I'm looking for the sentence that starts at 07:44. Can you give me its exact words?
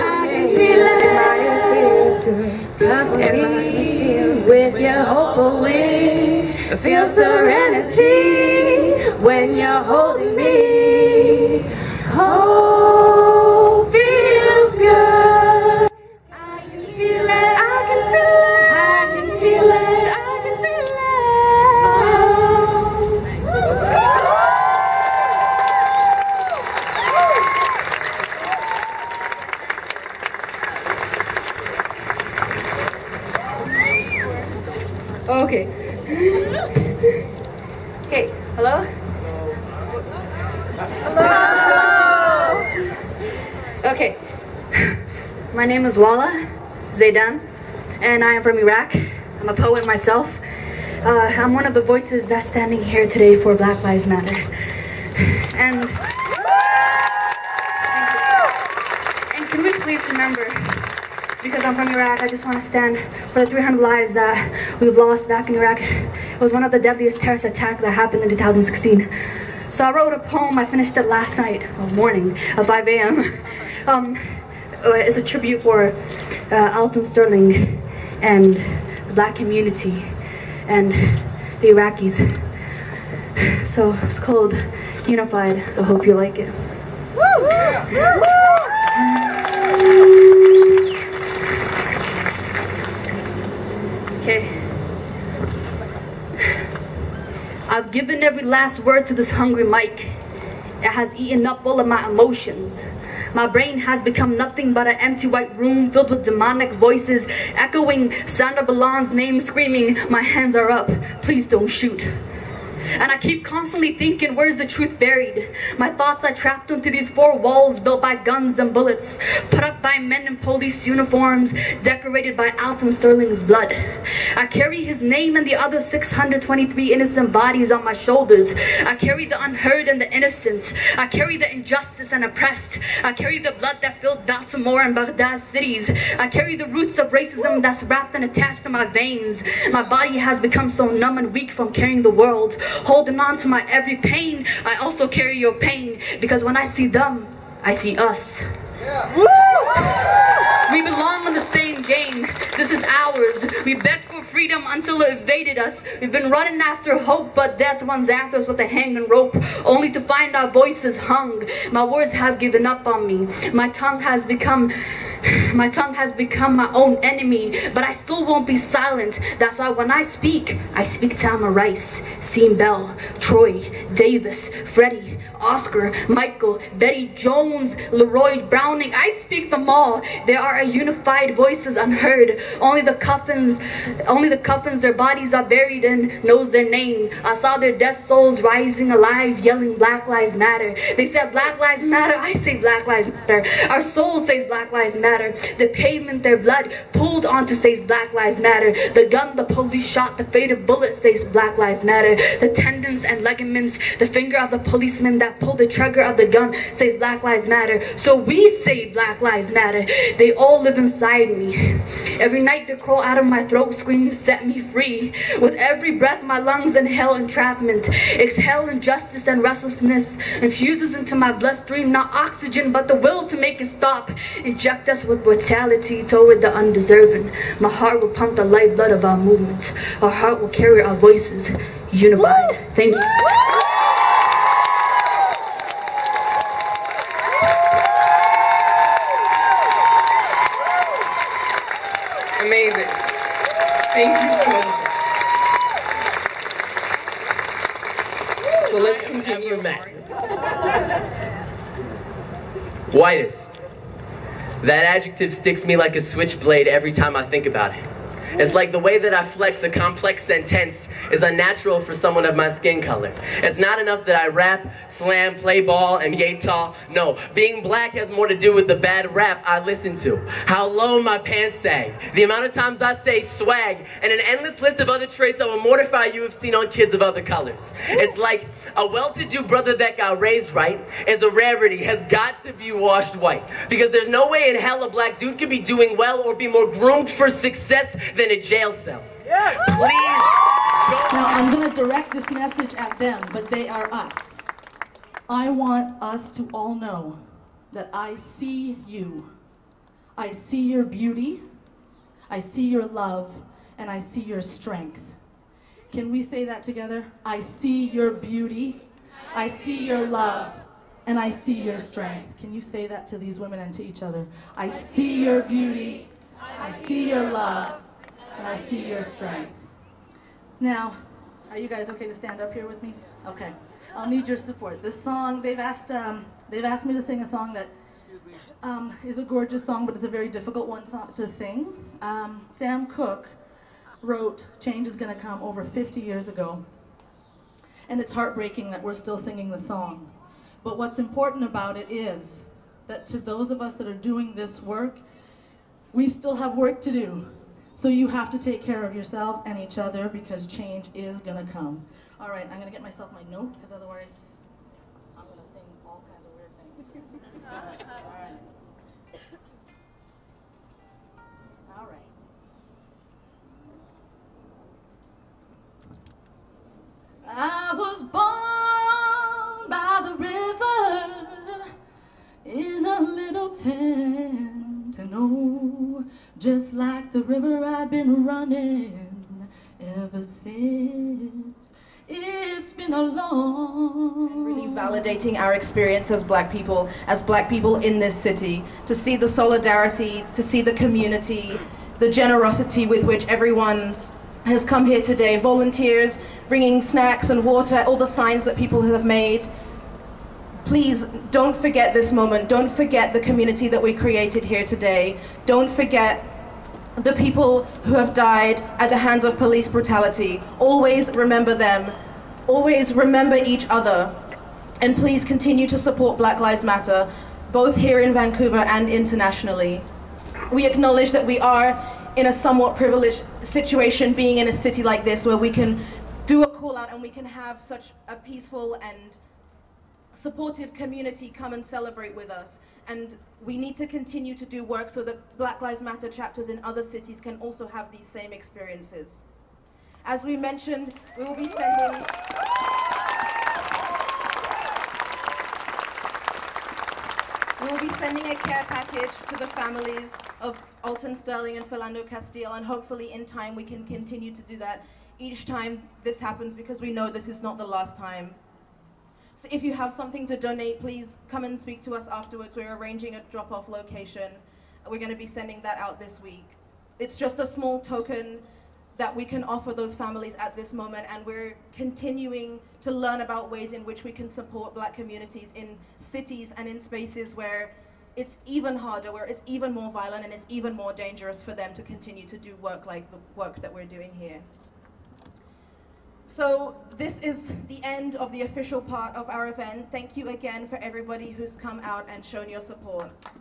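We're going to be sending that out this week.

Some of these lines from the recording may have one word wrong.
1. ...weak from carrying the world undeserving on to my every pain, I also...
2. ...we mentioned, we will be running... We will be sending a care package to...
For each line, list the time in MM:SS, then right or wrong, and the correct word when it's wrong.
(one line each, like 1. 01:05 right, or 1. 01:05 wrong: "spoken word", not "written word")
1. 02:21 wrong: "holding", not "undeserving"
2. 07:20 wrong: "sending", not "running".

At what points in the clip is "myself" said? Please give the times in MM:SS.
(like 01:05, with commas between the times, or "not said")
00:49, 05:52.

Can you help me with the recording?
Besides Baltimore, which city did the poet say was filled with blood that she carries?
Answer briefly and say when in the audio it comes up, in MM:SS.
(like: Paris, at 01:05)
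Baghdad, at 02:14.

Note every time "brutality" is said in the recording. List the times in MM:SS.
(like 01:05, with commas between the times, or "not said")
03:45, 06:49.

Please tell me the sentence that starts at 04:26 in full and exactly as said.
No, being black has more to do with the bad rap I listen to.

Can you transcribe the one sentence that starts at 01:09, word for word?
So I wrote a poem, I finished it last night, or morning, at 5 a.m.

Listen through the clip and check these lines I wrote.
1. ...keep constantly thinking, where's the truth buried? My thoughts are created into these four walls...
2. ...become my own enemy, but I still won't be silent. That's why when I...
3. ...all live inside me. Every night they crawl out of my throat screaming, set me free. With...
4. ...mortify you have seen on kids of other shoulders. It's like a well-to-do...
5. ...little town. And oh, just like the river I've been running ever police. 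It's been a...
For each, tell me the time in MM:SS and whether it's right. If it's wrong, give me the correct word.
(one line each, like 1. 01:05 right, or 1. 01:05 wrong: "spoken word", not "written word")
1. 01:53 wrong: "trapped", not "created"
2. 02:46 right
3. 03:30 right
4. 04:35 wrong: "colors", not "shoulders"
5. 06:13 wrong: "since", not "police".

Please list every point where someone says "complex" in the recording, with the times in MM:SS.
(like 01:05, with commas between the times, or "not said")
04:19.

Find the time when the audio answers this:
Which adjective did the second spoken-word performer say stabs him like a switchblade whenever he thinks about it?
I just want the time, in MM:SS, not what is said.
04:12.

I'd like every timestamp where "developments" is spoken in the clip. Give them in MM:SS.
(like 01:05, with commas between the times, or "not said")
not said.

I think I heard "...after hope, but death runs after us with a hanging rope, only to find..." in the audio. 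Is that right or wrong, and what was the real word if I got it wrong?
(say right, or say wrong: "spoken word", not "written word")
right.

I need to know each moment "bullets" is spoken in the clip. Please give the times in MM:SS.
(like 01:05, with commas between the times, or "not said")
01:58, 03:20.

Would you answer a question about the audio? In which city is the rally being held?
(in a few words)
Vancouver.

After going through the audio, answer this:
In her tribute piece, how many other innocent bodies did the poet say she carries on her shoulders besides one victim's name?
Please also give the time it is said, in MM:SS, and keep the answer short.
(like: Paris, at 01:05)
623, at 02:05.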